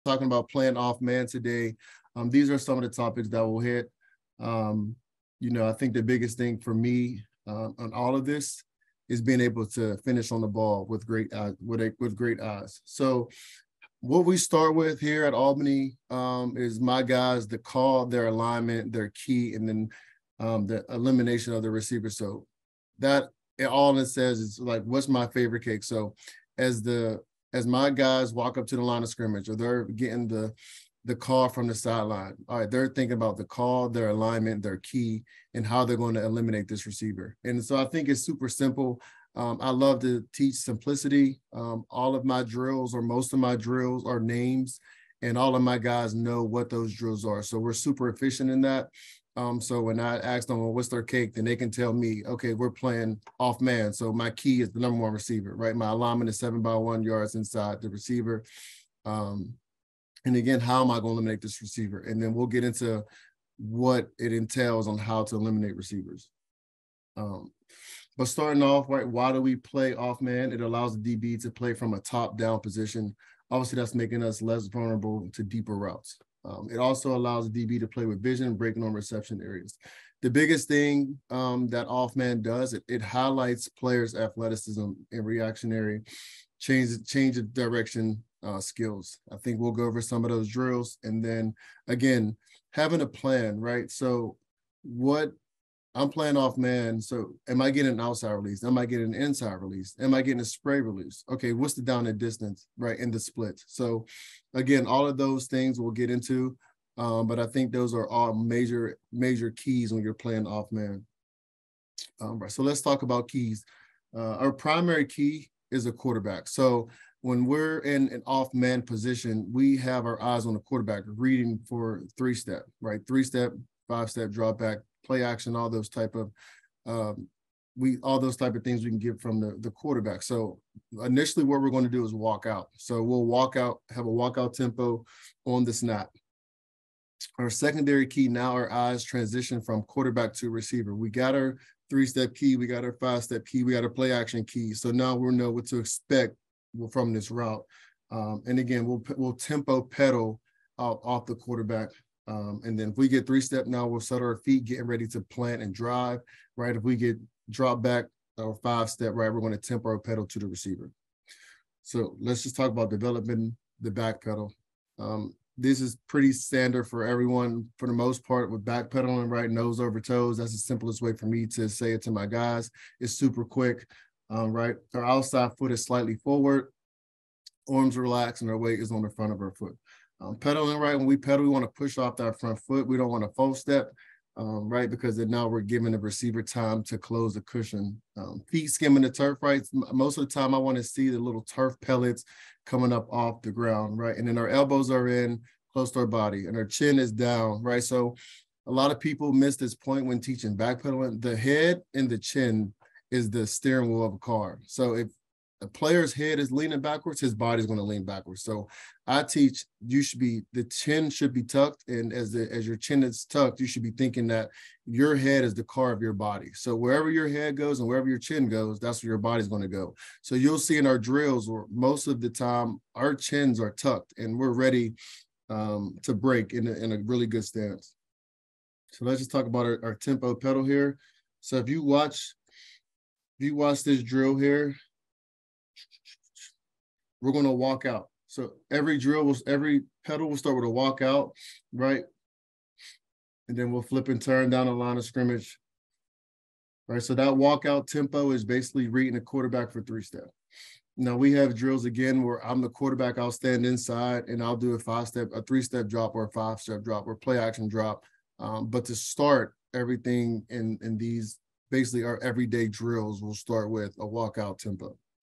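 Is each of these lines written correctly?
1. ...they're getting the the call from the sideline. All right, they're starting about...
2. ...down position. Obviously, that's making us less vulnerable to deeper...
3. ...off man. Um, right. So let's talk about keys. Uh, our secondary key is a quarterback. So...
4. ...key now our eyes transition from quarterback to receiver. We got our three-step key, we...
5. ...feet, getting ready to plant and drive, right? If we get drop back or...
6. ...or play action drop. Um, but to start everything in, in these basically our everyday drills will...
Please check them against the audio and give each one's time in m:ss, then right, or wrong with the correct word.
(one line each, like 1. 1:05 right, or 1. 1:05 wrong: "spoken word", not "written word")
1. 0:29 wrong: "thinking", not "starting"
2. 1:12 right
3. 1:50 wrong: "primary", not "secondary"
4. 2:18 right
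5. 2:34 right
6. 4:17 right.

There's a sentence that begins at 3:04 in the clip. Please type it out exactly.
Because then now we're giving the receiver time to close the cushion.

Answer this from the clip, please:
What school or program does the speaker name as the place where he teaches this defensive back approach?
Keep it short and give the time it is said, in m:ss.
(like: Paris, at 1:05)
Albany, at 0:15.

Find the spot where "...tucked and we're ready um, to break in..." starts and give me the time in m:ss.
3:43.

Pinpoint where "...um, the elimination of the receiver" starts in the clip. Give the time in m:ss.
0:20.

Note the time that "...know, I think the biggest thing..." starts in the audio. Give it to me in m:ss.
0:05.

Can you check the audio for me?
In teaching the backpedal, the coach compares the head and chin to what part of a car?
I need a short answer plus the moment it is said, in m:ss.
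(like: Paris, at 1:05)
the steering wheel, at 3:23.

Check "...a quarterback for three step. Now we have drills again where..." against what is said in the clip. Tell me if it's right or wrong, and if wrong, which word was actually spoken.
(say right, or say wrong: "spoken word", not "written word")
right.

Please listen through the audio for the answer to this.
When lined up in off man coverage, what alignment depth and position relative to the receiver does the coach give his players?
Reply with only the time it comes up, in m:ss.
0:56.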